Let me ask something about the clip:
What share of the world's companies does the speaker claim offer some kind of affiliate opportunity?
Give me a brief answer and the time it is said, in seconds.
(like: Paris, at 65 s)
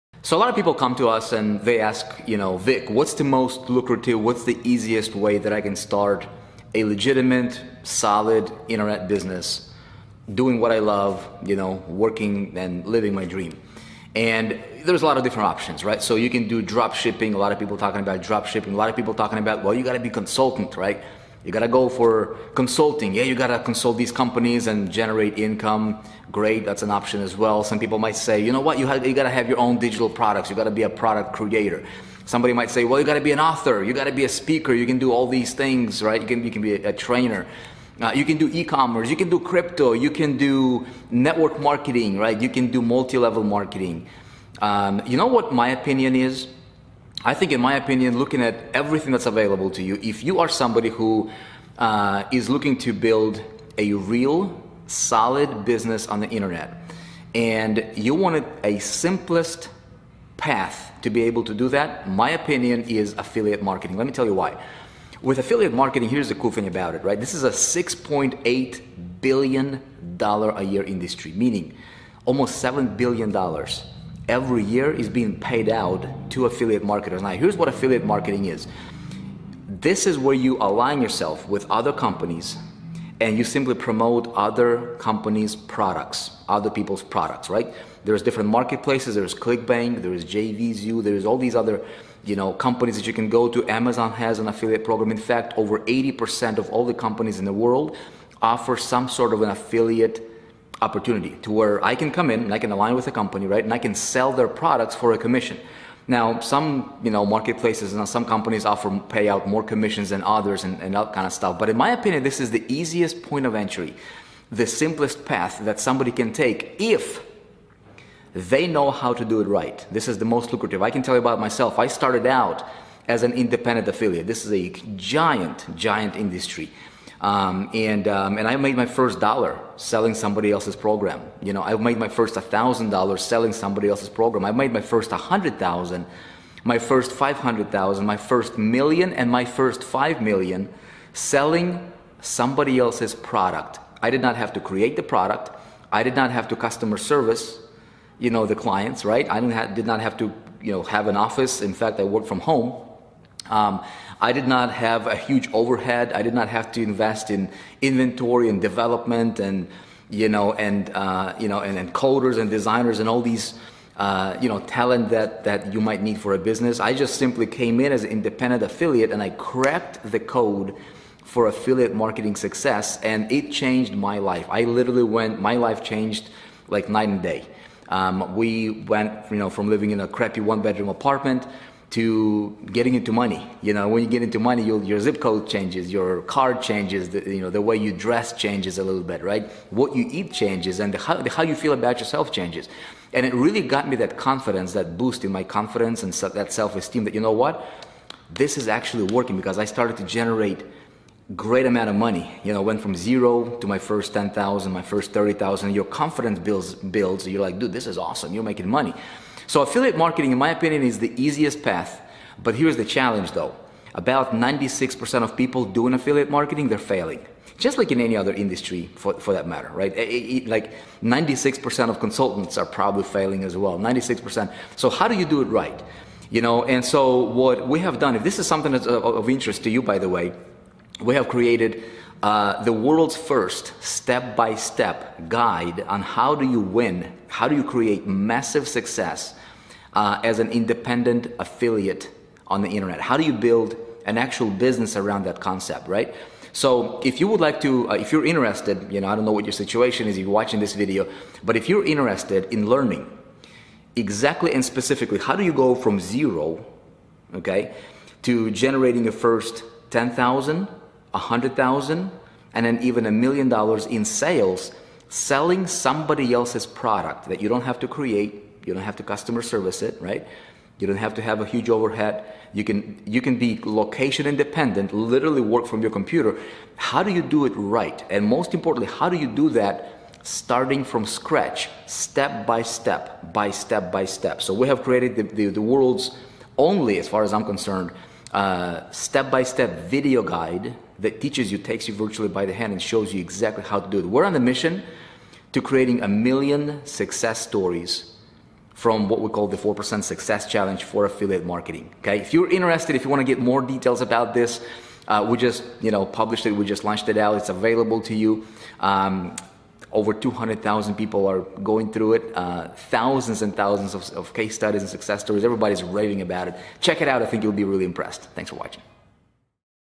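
over 80%, at 95 s.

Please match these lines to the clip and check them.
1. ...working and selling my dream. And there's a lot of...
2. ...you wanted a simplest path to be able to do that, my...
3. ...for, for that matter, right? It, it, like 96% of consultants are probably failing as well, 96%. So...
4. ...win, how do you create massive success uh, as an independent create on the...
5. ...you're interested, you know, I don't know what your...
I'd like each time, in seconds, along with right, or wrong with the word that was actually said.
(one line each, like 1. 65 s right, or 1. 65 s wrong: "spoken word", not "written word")
1. 11 s wrong: "living", not "selling"
2. 57 s right
3. 218 s right
4. 236 s wrong: "affiliate", not "create"
5. 248 s right.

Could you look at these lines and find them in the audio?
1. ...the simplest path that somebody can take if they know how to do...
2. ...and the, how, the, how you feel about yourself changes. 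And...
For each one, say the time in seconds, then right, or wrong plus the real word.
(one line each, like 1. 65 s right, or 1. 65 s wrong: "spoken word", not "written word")
1. 114 s right
2. 190 s right.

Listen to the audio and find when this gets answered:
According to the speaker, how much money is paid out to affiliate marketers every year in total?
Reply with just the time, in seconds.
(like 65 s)
67 s.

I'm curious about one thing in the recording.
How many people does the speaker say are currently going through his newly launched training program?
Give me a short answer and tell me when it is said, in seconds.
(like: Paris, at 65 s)
over 200,000, at 309 s.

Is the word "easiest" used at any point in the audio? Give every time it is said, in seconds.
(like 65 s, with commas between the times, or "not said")
4 s, 112 s, 211 s.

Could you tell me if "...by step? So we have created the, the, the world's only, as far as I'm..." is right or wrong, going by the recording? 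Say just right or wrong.
right.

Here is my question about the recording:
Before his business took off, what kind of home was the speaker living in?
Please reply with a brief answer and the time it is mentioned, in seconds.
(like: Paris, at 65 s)
one bedroom apartment, at 180 s.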